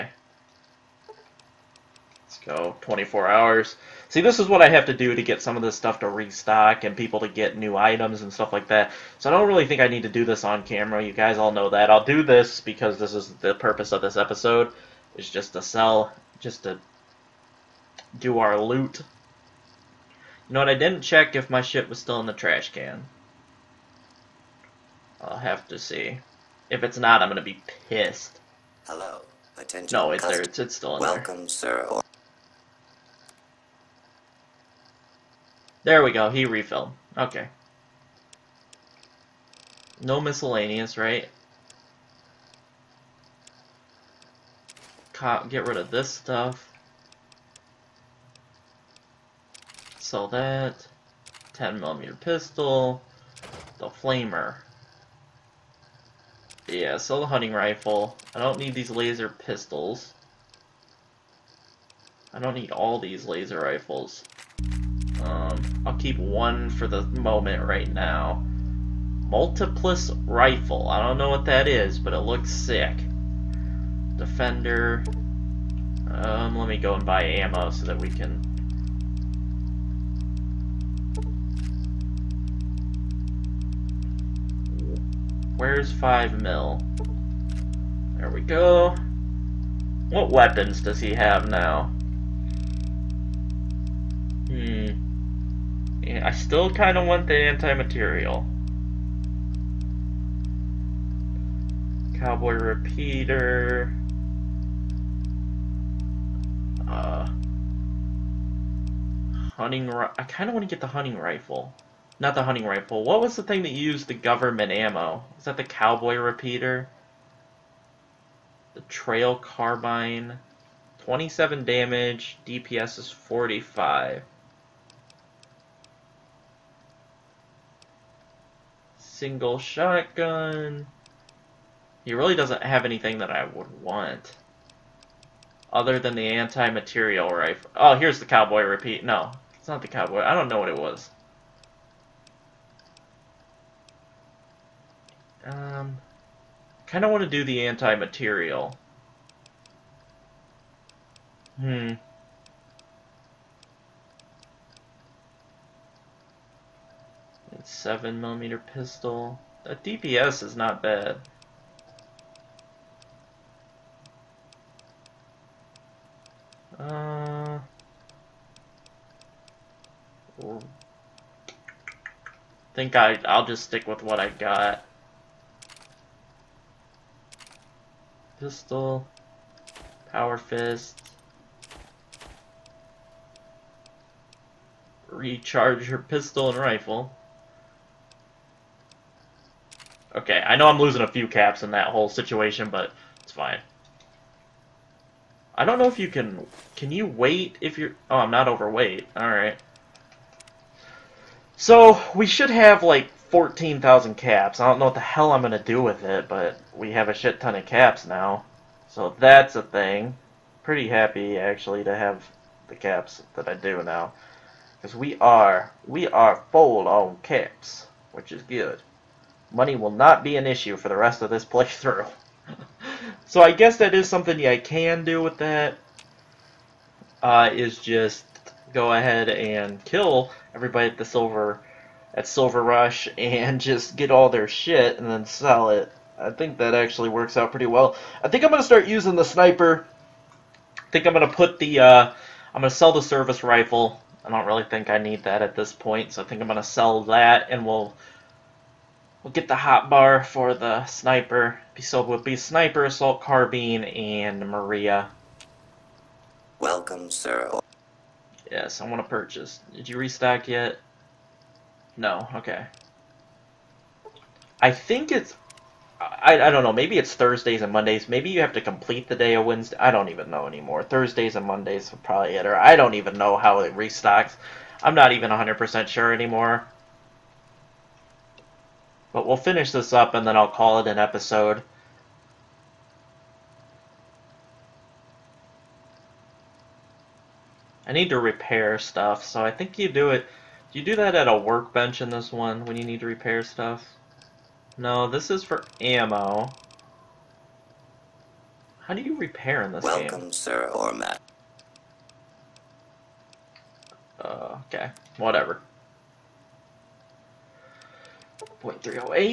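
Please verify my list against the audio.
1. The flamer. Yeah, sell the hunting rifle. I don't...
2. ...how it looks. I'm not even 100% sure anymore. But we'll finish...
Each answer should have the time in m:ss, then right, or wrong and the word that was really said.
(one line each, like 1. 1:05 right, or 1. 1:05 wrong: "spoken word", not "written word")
1. 0:53 right
2. 4:33 wrong: "restocks", not "looks".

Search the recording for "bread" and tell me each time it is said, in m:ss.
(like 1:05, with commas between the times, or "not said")
not said.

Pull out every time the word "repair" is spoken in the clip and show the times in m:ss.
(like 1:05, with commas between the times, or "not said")
4:48, 4:53, 4:59.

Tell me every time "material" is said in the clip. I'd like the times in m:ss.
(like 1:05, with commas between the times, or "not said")
1:37, 2:16, 2:27.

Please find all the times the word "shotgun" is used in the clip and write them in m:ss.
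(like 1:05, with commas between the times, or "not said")
2:09.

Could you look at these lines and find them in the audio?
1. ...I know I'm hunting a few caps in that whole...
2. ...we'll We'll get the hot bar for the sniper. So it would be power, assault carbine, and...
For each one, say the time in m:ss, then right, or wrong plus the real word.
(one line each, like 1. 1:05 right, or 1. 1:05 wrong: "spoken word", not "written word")
1. 3:10 wrong: "losing", not "hunting"
2. 4:07 wrong: "sniper", not "power".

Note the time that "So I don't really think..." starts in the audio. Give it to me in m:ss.
0:09.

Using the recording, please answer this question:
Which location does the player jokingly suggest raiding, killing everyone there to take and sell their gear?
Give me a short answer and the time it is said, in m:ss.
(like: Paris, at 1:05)
Silver Rush, at 3:52.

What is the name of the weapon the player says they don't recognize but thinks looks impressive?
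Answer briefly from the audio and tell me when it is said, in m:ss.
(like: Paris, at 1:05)
Multiplas Rifle, at 1:09.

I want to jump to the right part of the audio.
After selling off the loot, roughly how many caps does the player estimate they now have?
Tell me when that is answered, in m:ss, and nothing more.
3:23.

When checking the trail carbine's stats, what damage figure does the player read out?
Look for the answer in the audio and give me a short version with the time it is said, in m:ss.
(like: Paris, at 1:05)
27, at 2:00.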